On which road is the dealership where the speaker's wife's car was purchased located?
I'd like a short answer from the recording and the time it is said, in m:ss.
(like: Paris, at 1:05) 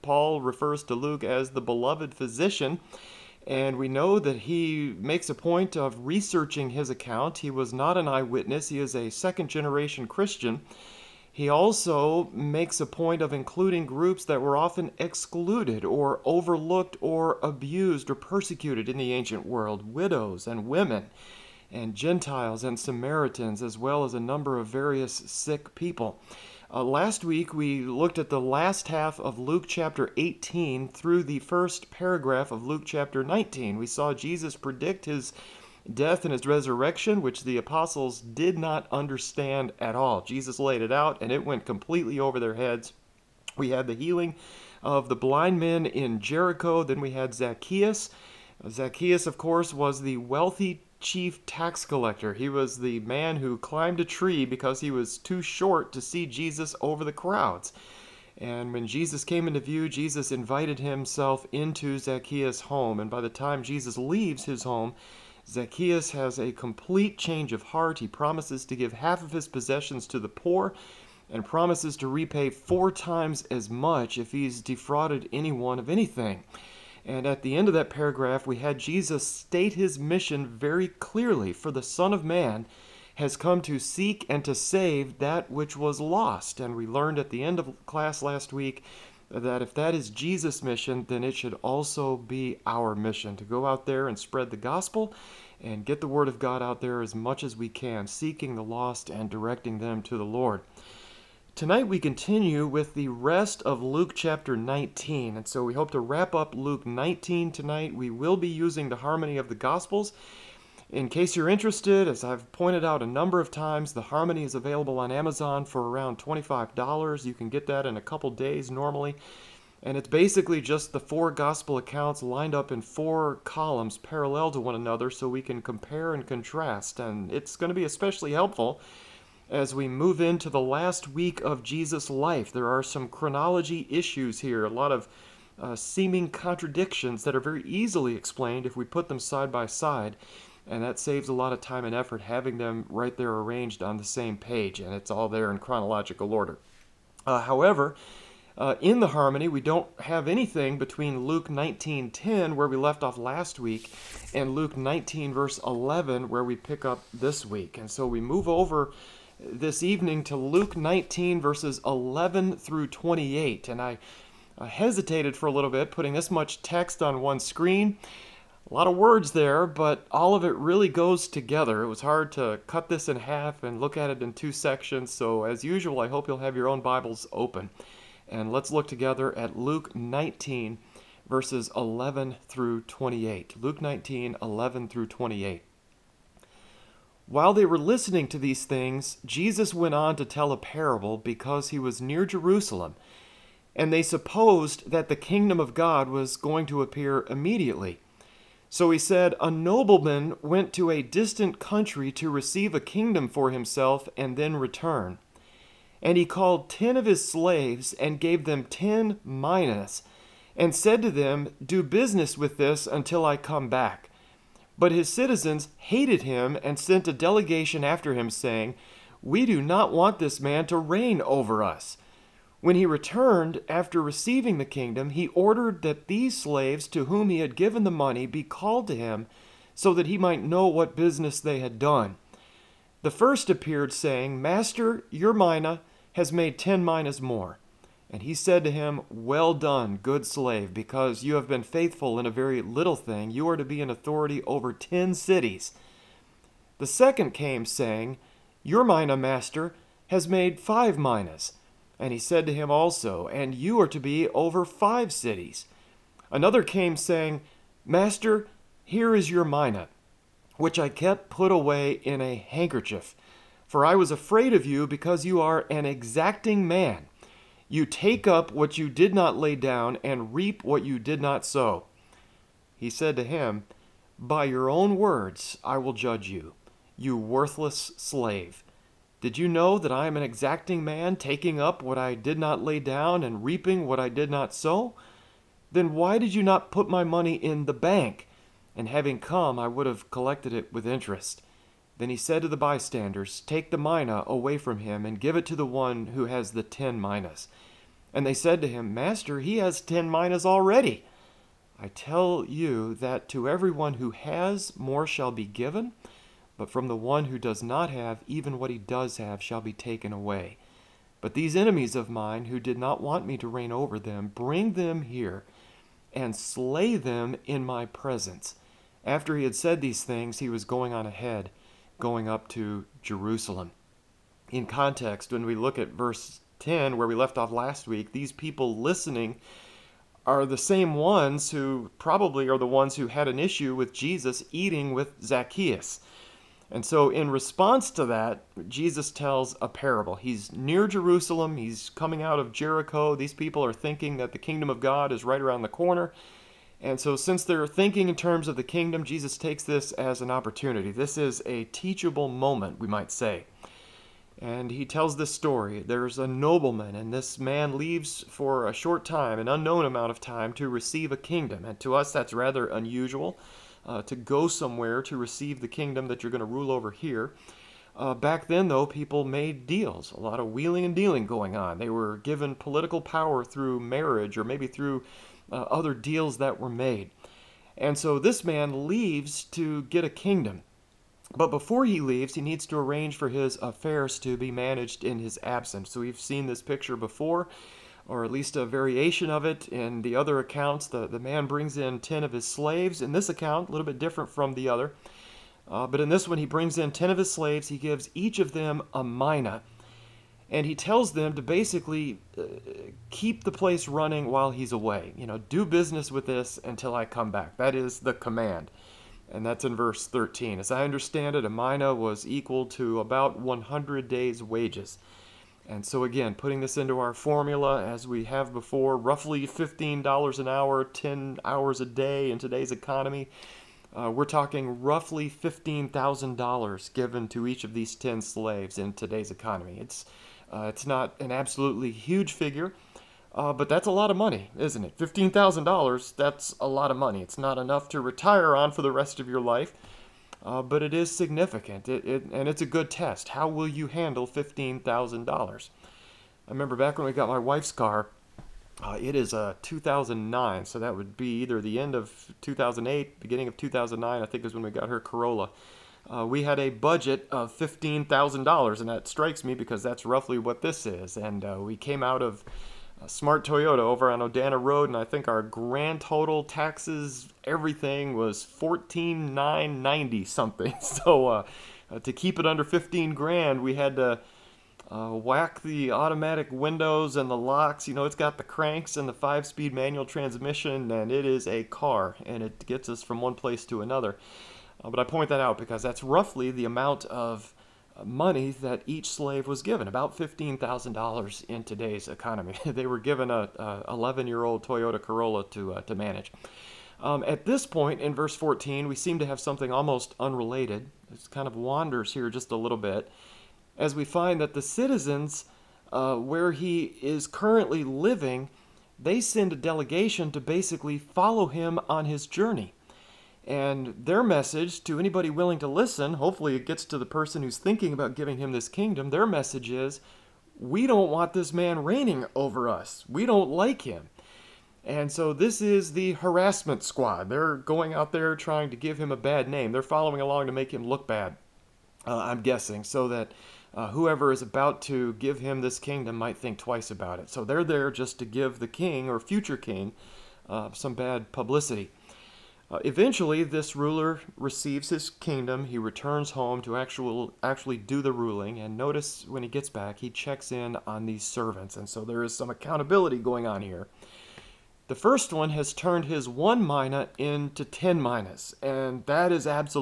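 Odana Road, at 7:44.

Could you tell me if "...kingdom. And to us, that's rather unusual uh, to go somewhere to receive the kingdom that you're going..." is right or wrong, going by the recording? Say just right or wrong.
right.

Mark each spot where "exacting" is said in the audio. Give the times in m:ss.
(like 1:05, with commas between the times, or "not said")
4:25, 4:40.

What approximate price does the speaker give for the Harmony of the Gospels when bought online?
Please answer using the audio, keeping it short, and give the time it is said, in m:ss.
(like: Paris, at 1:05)
$25, at 1:55.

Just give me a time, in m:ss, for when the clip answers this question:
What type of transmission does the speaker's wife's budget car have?
7:59.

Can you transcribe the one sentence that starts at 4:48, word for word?
And having come, I would have collected it with interest.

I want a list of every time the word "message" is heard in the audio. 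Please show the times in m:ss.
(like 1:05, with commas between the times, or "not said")
8:34, 8:39.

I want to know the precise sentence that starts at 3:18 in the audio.
So he said, A nobleman went to a distant country to receive a kingdom for himself and then return.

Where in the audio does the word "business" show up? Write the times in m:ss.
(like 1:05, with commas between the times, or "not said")
3:31, 3:50, 6:45.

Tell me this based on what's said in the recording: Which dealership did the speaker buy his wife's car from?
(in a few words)
Smart Toyota.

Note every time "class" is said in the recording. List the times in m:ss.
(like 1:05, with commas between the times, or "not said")
1:27.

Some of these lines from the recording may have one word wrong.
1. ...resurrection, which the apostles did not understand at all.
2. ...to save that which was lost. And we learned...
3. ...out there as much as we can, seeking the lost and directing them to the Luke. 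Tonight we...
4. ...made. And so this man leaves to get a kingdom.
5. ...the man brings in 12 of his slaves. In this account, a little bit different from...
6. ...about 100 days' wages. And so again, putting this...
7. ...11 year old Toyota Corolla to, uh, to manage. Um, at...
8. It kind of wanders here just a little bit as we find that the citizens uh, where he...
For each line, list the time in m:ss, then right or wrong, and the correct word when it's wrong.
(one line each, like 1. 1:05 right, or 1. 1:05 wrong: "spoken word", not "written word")
1. 0:36 right
2. 1:24 right
3. 1:36 wrong: "Lord", not "Luke"
4. 6:16 right
5. 6:31 wrong: "10", not "12"
6. 6:52 right
7. 8:13 right
8. 8:21 right.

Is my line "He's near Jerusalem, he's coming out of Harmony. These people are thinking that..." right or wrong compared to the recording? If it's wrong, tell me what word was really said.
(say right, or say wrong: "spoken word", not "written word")
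wrong: "Jericho", not "Harmony".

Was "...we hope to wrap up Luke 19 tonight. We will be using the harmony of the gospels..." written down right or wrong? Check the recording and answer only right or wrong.
right.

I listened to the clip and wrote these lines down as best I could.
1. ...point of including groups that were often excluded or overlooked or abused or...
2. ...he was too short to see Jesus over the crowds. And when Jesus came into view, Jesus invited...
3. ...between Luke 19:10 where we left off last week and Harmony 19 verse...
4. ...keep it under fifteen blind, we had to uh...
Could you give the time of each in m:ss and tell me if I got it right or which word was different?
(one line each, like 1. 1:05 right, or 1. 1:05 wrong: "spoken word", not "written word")
1. 0:12 right
2. 0:54 right
3. 2:30 wrong: "Luke", not "Harmony"
4. 7:52 wrong: "grand", not "blind".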